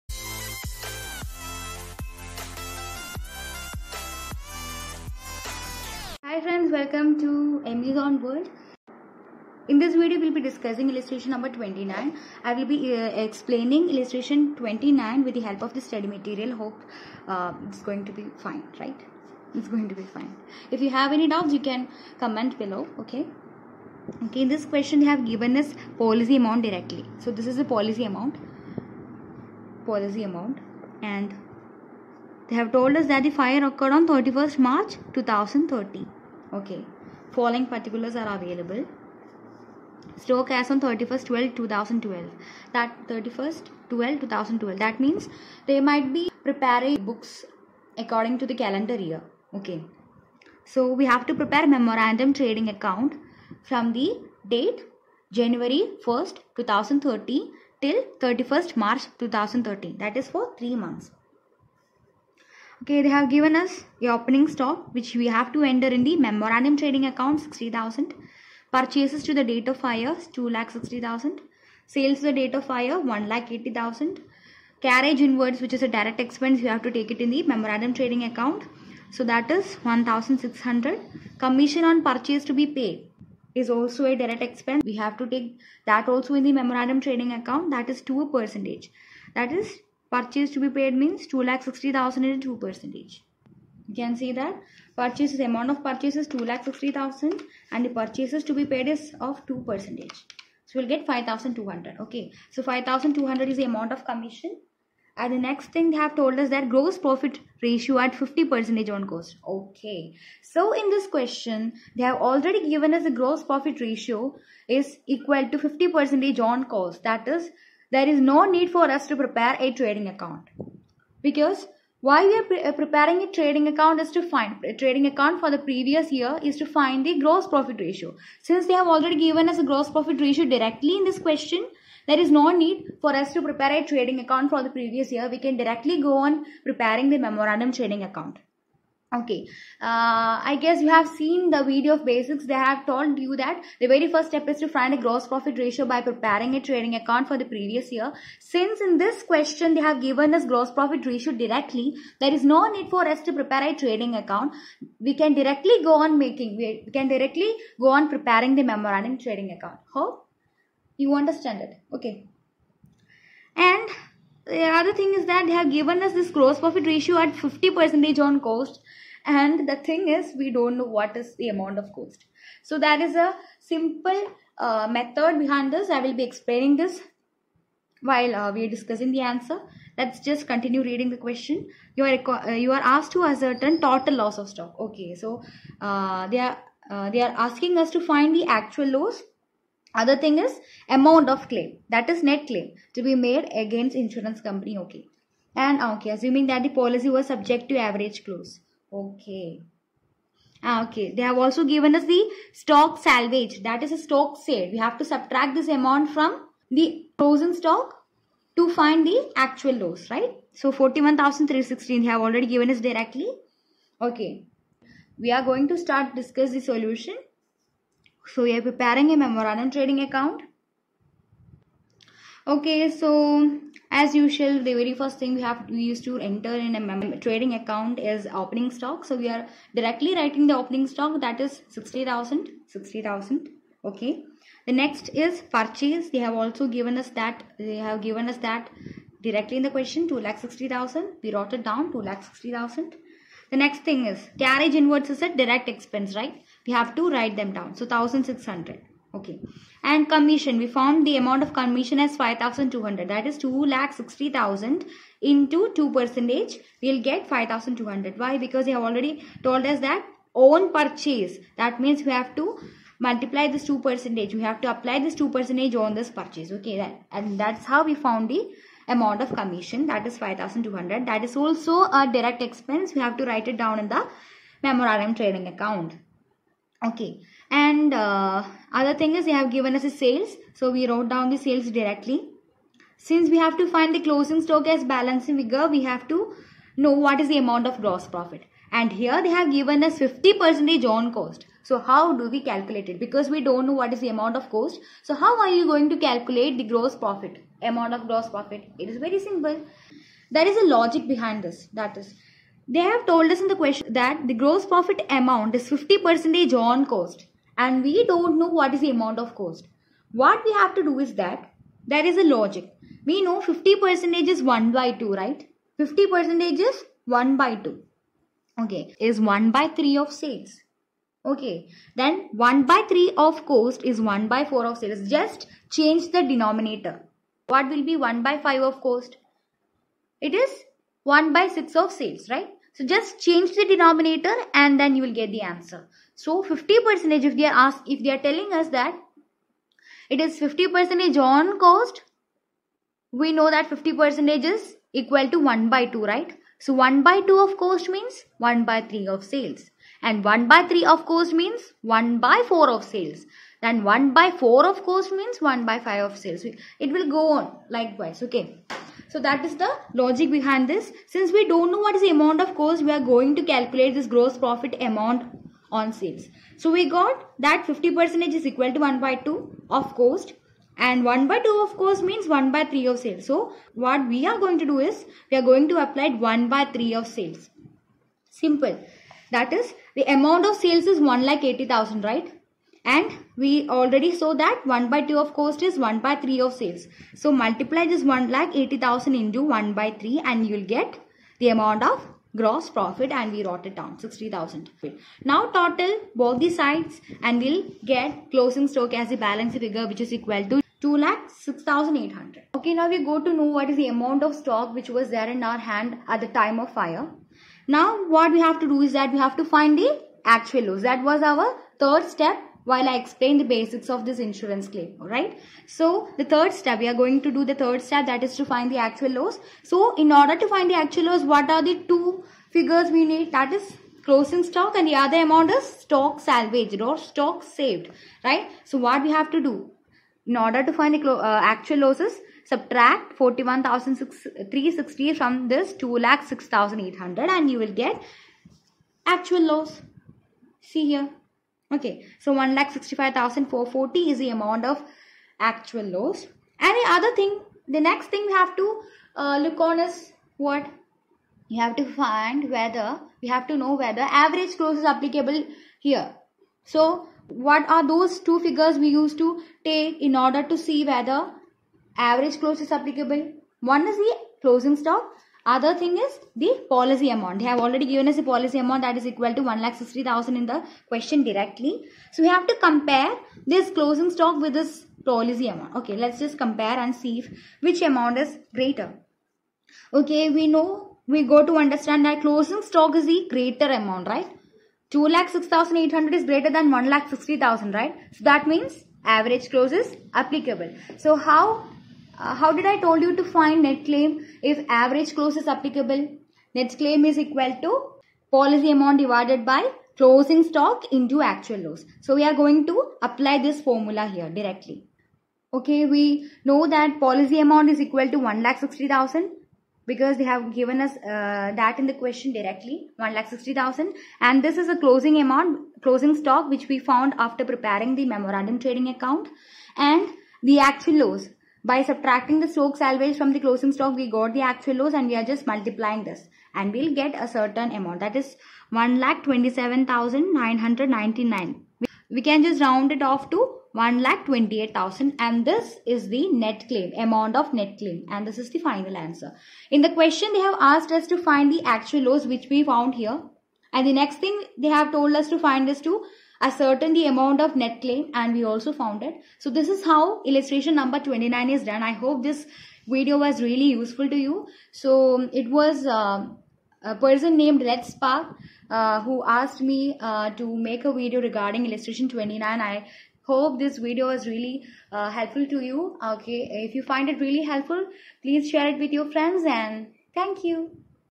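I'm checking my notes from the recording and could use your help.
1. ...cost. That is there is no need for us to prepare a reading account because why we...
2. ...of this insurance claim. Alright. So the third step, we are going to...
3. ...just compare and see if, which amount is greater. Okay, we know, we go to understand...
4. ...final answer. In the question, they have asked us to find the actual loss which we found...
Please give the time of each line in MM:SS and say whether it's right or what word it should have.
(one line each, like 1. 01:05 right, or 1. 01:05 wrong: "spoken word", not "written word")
1. 01:56 wrong: "trading", not "reading"
2. 06:53 right
3. 07:56 right
4. 08:58 right.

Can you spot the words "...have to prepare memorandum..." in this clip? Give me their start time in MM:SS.
00:51.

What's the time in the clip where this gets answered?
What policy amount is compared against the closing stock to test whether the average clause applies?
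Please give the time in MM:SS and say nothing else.
07:48.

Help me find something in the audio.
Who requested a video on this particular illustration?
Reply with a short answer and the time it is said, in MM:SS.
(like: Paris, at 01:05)
Red Spark, at 09:17.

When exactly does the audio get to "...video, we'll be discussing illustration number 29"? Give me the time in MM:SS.
00:09.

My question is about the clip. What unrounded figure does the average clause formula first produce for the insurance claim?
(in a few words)
1,27,999.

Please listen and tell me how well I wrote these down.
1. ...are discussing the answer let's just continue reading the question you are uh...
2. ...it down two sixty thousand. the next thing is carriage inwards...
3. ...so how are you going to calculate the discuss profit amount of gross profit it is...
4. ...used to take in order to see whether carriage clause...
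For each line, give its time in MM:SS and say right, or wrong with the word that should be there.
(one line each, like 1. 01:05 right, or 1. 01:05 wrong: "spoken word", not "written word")
1. 02:58 right
2. 04:01 right
3. 04:55 wrong: "gross", not "discuss"
4. 07:38 wrong: "average", not "carriage".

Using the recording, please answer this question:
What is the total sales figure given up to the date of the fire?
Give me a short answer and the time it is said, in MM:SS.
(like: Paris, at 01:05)
1,80,000, at 01:11.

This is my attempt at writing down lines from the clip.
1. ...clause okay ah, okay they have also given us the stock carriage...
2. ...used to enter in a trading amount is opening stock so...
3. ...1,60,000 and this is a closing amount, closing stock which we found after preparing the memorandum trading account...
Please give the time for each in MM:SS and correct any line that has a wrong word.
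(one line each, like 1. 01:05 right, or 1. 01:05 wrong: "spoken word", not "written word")
1. 03:18 wrong: "salvage", not "carriage"
2. 03:45 wrong: "account", not "amount"
3. 08:32 right.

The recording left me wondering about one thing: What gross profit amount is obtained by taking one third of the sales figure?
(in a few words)
60,000.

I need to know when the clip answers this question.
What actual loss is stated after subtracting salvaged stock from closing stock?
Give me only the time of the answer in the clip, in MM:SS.
07:22.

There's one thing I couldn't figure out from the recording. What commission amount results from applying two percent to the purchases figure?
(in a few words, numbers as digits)
5,200.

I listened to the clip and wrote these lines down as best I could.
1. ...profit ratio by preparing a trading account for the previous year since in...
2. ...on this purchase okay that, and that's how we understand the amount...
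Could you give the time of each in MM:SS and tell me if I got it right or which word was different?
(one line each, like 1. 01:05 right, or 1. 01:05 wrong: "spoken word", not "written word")
1. 02:25 right
2. 04:25 wrong: "found", not "understand".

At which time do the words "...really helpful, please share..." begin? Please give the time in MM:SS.
09:27.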